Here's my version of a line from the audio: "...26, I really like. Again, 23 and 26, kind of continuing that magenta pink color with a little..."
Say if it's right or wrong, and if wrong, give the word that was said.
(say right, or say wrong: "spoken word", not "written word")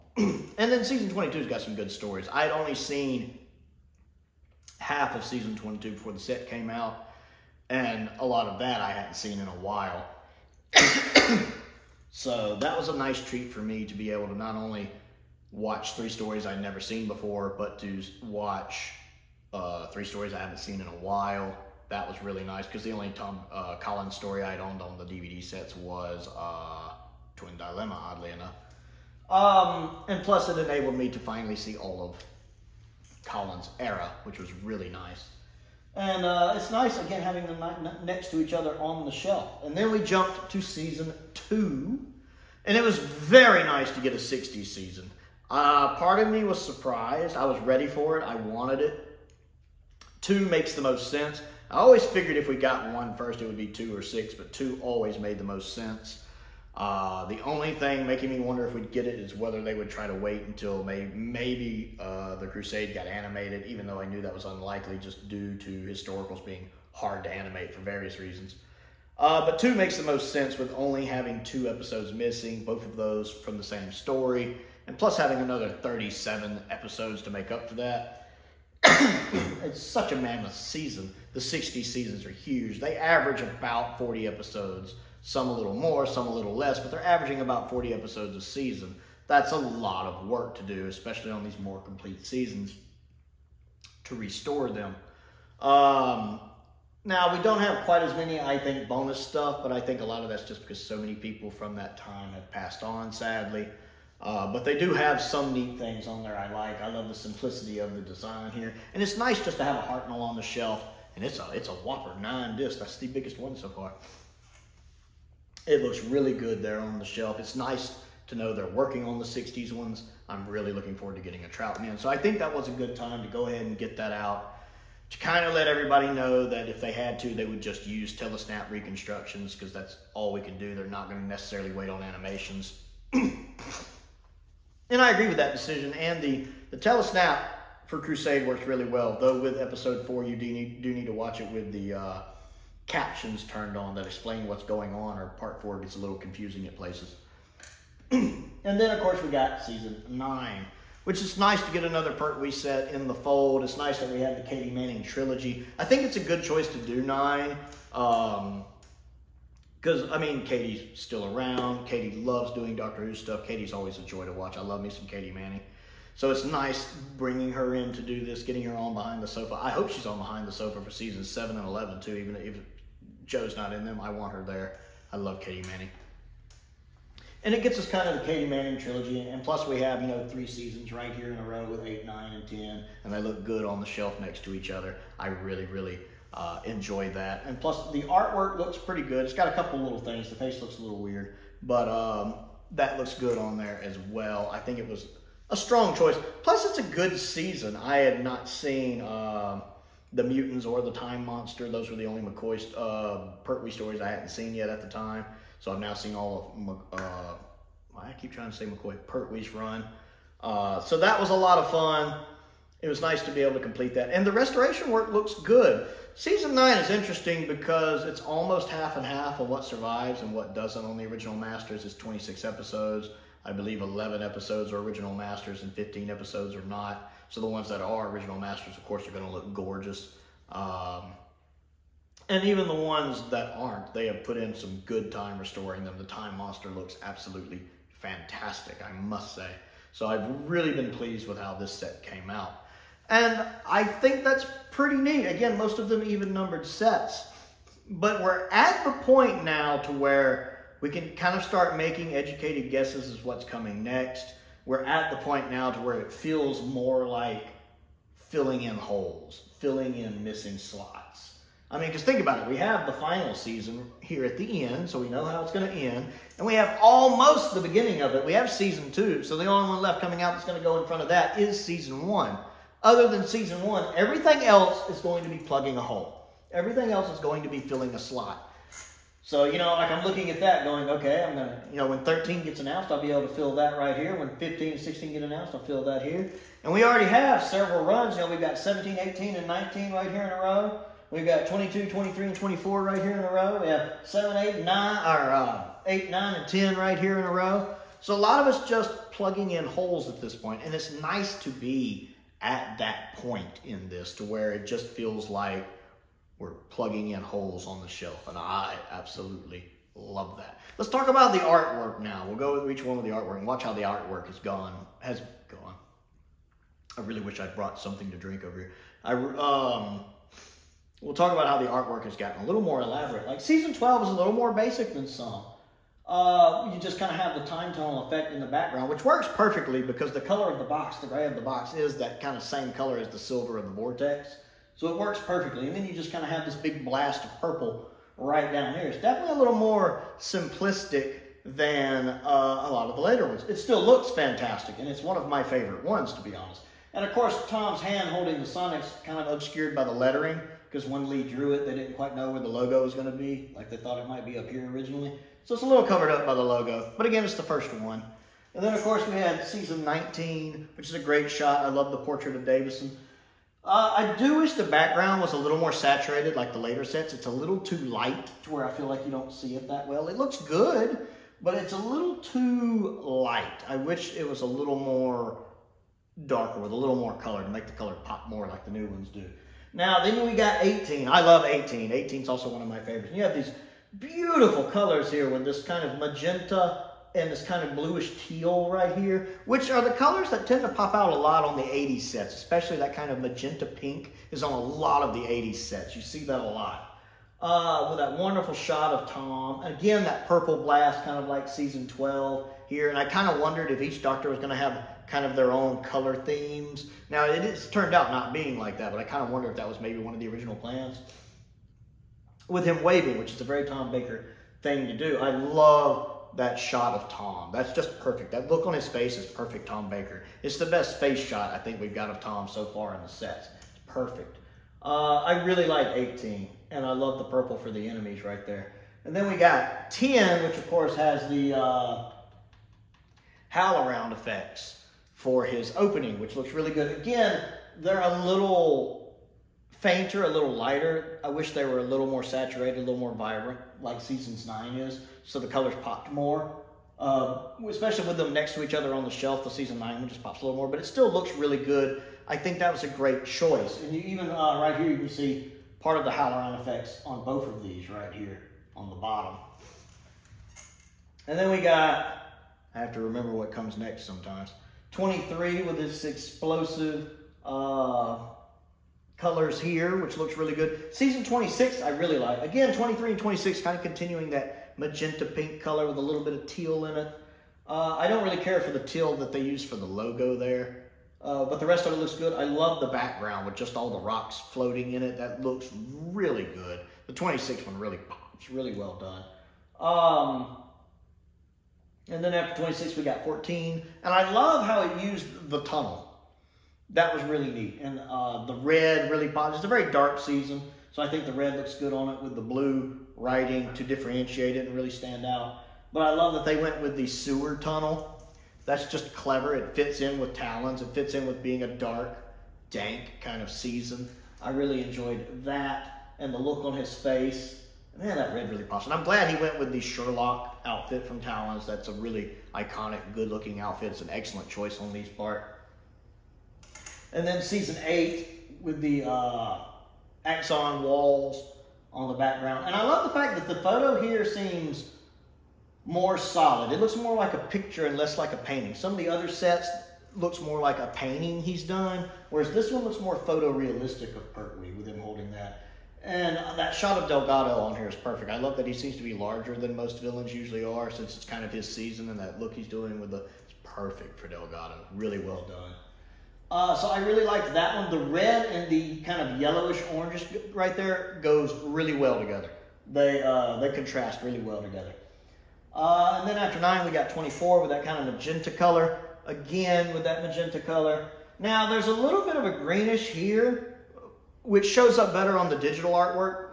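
right.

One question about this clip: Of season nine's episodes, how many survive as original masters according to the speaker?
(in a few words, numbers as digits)
11.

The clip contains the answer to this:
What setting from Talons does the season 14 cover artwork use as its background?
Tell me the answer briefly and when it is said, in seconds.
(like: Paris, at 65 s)
sewer tunnel, at 507 s.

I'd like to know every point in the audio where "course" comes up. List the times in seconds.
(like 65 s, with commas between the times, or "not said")
149 s, 228 s, 347 s, 358 s, 430 s.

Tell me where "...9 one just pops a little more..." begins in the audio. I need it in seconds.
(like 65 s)
449 s.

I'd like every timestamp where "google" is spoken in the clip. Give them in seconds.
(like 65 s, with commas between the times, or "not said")
not said.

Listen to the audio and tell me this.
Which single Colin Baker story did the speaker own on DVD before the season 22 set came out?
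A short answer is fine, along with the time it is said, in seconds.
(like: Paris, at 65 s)
Twin Dilemma, at 27 s.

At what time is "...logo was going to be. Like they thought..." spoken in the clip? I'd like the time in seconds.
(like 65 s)
352 s.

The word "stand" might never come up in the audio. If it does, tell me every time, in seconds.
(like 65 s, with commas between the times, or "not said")
504 s.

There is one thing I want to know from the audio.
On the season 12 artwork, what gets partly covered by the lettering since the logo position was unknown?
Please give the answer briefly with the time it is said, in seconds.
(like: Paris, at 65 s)
Tom's hand holding the Sonic, at 347 s.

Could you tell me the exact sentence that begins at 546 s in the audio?
And that shot of Delgado on here is perfect.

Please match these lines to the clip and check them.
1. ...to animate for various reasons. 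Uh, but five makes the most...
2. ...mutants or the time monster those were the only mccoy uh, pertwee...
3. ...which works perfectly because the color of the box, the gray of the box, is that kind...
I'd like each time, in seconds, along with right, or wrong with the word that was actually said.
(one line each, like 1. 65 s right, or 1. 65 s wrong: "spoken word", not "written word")
1. 67 s wrong: "two", not "five"
2. 200 s right
3. 328 s right.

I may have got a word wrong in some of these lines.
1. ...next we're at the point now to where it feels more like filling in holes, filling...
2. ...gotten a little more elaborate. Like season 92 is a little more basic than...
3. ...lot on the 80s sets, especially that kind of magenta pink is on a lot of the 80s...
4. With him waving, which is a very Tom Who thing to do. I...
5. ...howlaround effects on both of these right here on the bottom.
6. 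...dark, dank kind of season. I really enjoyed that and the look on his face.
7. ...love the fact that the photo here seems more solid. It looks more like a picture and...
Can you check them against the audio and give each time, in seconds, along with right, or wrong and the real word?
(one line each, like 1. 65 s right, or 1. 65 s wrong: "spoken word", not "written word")
1. 253 s right
2. 322 s wrong: "12", not "92"
3. 391 s right
4. 412 s wrong: "Baker", not "Who"
5. 456 s right
6. 511 s right
7. 532 s right.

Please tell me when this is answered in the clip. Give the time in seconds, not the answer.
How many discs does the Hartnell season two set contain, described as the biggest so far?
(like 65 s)
112 s.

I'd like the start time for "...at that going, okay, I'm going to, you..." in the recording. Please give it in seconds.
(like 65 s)
280 s.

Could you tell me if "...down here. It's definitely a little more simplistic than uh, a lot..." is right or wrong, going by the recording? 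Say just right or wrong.
right.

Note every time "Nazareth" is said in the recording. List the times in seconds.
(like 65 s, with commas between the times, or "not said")
not said.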